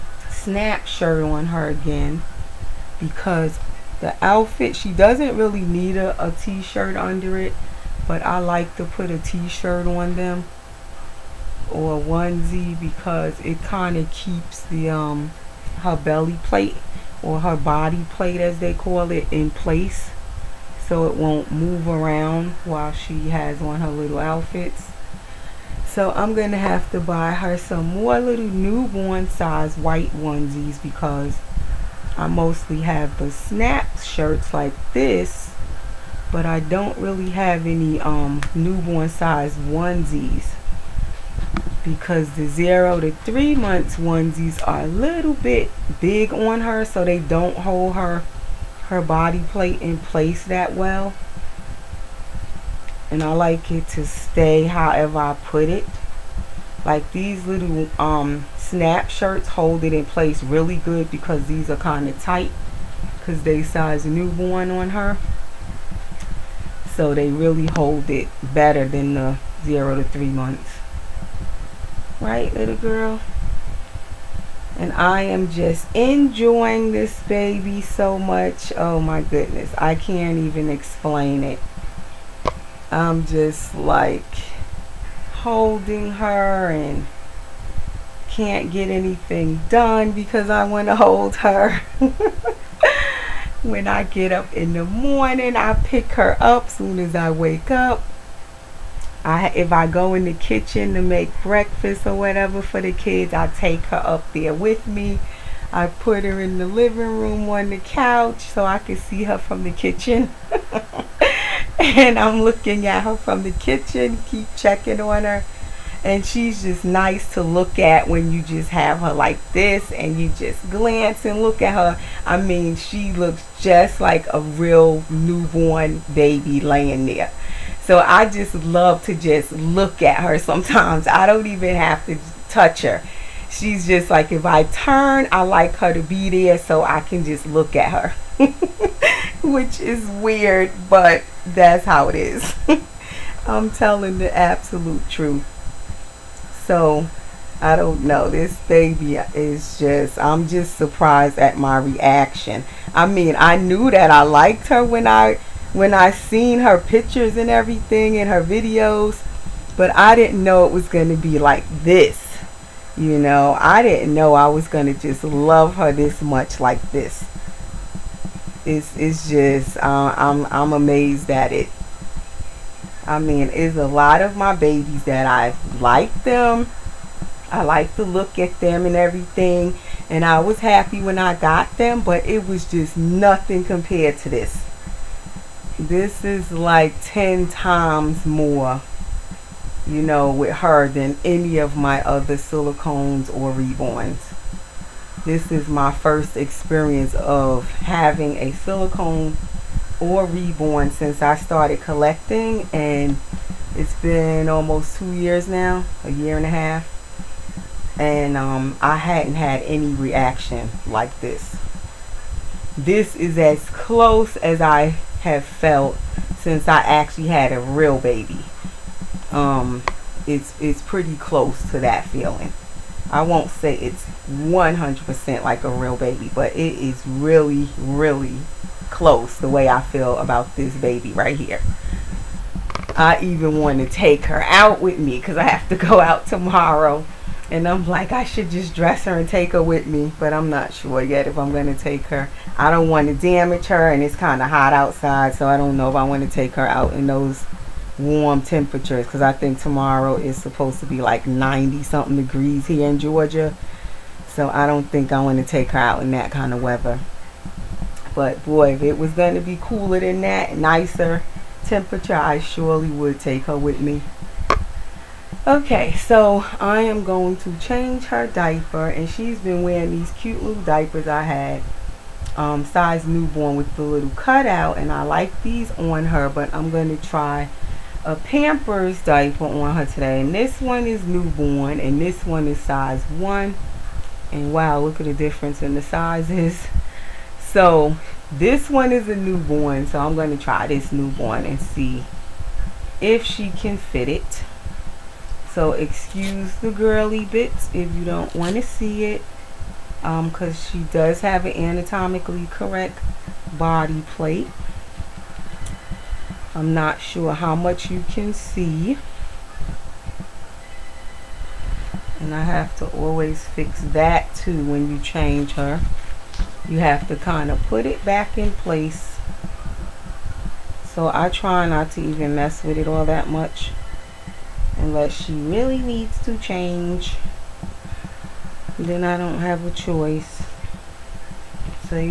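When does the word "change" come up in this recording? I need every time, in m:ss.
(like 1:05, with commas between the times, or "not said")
4:27, 5:14, 5:26.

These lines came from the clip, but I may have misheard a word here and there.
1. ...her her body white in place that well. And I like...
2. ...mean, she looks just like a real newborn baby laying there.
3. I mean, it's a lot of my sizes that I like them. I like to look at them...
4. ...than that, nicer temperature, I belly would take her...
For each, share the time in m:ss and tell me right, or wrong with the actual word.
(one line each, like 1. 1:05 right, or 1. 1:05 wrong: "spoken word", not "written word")
1. 0:47 wrong: "plate", not "white"
2. 2:02 right
3. 2:53 wrong: "babies", not "sizes"
4. 4:20 wrong: "surely", not "belly".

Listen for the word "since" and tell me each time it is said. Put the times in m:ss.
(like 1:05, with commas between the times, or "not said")
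3:20, 3:36.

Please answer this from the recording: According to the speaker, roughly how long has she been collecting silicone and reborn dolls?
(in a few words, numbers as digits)
a year and a half.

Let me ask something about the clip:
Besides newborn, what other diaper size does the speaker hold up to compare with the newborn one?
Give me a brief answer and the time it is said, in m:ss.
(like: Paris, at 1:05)
size 1, at 4:42.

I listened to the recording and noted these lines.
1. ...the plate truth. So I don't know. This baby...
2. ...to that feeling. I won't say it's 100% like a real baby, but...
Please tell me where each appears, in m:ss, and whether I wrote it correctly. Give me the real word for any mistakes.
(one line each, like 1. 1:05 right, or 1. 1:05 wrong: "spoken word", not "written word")
1. 2:24 wrong: "absolute", not "plate"
2. 3:41 right.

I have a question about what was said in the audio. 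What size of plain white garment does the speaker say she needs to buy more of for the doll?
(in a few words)
newborn size white onesies.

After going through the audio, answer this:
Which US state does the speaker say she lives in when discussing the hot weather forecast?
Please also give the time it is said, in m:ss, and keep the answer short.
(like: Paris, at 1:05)
Georgia, at 4:12.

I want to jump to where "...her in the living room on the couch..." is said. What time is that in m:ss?
1:46.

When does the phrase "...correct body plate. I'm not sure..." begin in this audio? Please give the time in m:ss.
5:02.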